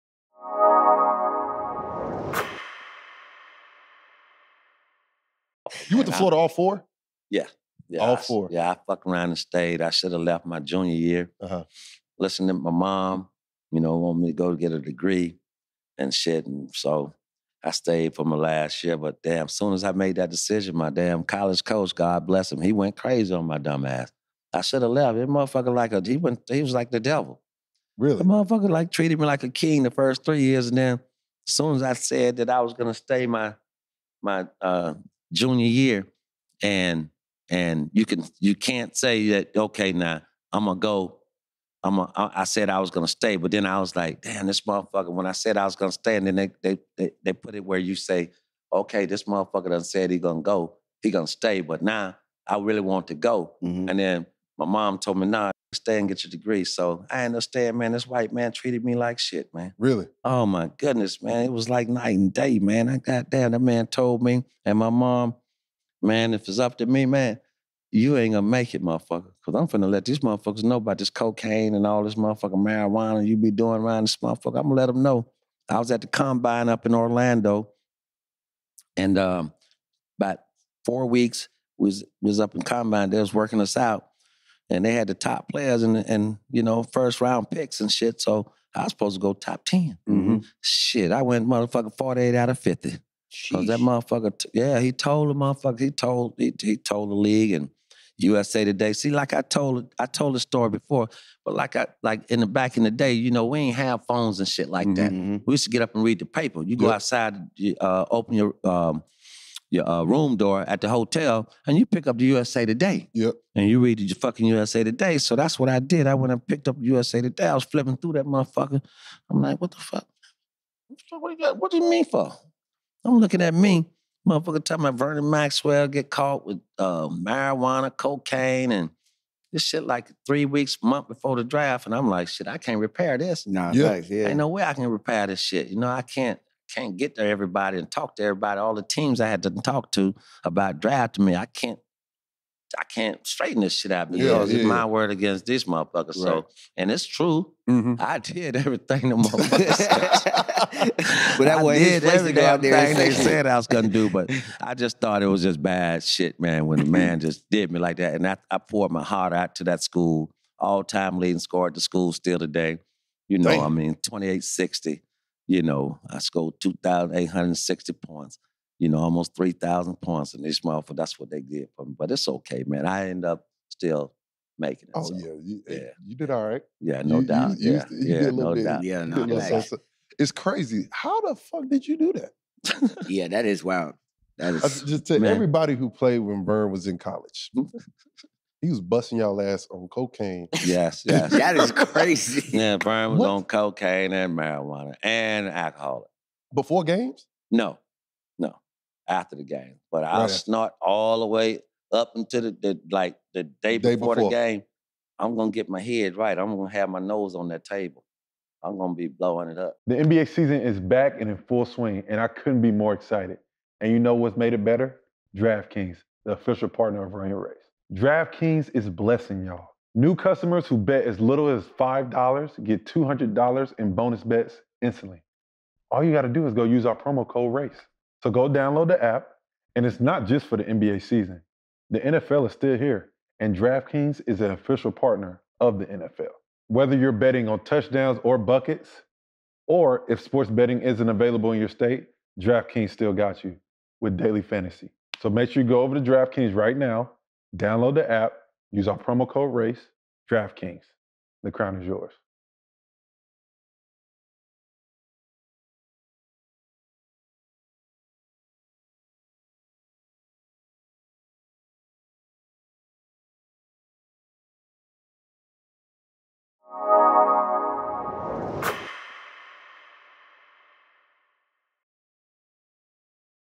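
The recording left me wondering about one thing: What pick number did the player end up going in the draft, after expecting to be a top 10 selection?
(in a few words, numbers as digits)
48.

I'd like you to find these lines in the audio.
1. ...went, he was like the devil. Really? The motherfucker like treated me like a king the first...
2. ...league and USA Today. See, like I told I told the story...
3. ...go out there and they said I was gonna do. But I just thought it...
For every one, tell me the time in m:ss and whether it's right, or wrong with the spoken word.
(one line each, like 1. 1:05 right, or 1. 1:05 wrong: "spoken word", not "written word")
1. 0:26 right
2. 1:37 right
3. 2:32 right.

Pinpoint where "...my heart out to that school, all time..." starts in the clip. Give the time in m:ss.
2:38.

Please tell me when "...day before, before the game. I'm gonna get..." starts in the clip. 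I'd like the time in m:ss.
3:23.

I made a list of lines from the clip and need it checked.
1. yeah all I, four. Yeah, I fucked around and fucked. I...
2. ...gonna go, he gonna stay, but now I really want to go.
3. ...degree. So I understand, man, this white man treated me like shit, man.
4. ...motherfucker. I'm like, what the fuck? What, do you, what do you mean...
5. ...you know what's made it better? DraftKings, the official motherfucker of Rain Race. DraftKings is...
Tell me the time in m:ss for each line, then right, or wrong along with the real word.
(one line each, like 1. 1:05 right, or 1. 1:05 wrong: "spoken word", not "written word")
1. 0:07 wrong: "stayed", not "fucked"
2. 0:50 right
3. 0:56 right
4. 1:58 right
5. 3:33 wrong: "partner", not "motherfucker".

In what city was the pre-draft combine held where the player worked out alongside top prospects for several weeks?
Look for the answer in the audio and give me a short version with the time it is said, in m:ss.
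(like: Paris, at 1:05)
Orlando, at 1:16.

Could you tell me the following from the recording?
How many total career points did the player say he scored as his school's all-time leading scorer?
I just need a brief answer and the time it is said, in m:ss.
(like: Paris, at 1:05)
2,860, at 2:46.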